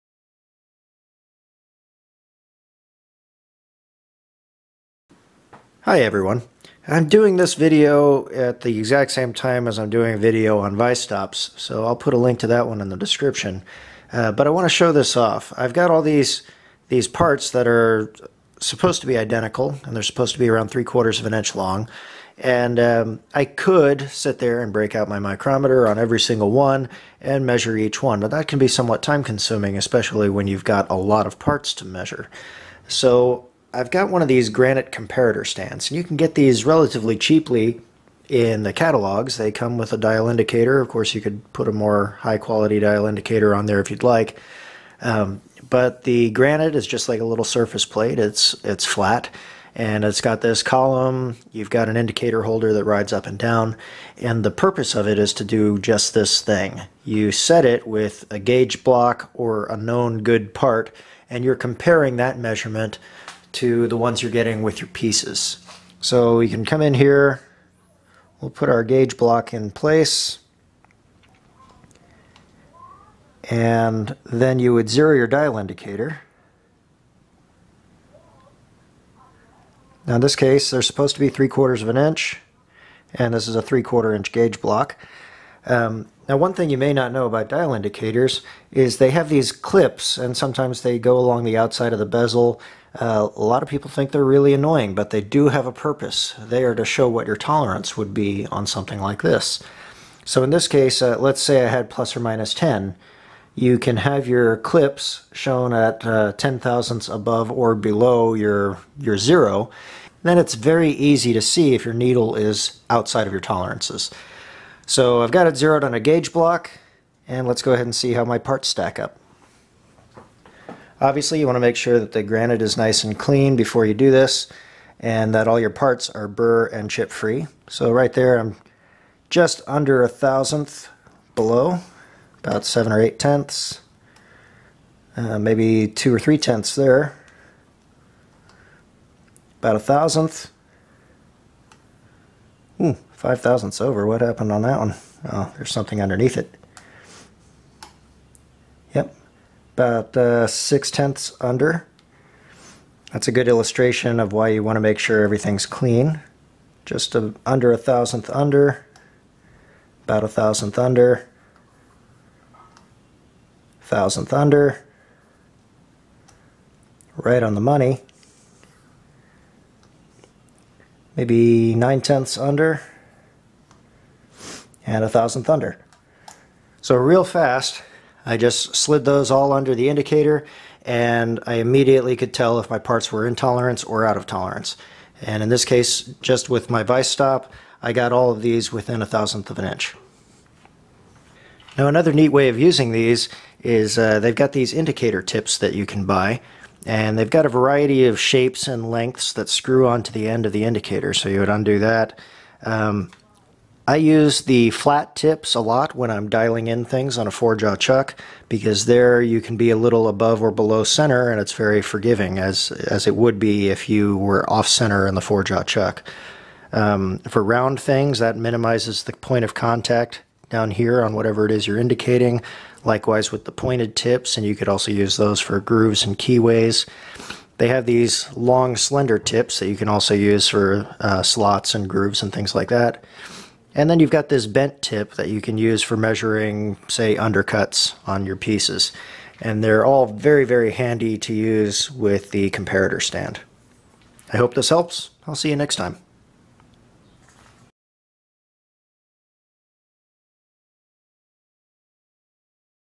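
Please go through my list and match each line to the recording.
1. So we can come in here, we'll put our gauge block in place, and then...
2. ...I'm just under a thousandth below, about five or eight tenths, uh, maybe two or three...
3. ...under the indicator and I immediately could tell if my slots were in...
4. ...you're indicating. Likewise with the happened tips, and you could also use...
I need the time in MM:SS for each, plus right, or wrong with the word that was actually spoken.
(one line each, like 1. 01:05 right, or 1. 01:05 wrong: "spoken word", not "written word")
1. 01:05 right
2. 02:08 wrong: "seven", not "five"
3. 02:59 wrong: "parts", not "slots"
4. 03:41 wrong: "pointed", not "happened".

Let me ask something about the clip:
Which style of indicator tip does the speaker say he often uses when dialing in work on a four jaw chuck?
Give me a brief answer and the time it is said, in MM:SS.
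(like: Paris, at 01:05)
Flat tips, at 03:24.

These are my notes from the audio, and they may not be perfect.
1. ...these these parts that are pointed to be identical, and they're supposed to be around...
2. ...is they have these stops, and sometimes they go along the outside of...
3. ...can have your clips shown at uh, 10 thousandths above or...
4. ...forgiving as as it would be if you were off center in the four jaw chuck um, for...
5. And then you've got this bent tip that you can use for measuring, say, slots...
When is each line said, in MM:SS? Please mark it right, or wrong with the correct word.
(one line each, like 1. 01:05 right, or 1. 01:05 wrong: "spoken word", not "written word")
1. 00:16 wrong: "supposed", not "pointed"
2. 01:28 wrong: "clips", not "stops"
3. 01:43 right
4. 03:31 right
5. 03:53 wrong: "undercuts", not "slots".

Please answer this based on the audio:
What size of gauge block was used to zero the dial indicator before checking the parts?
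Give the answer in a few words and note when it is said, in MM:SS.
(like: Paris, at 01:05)
3/4 inch, at 01:23.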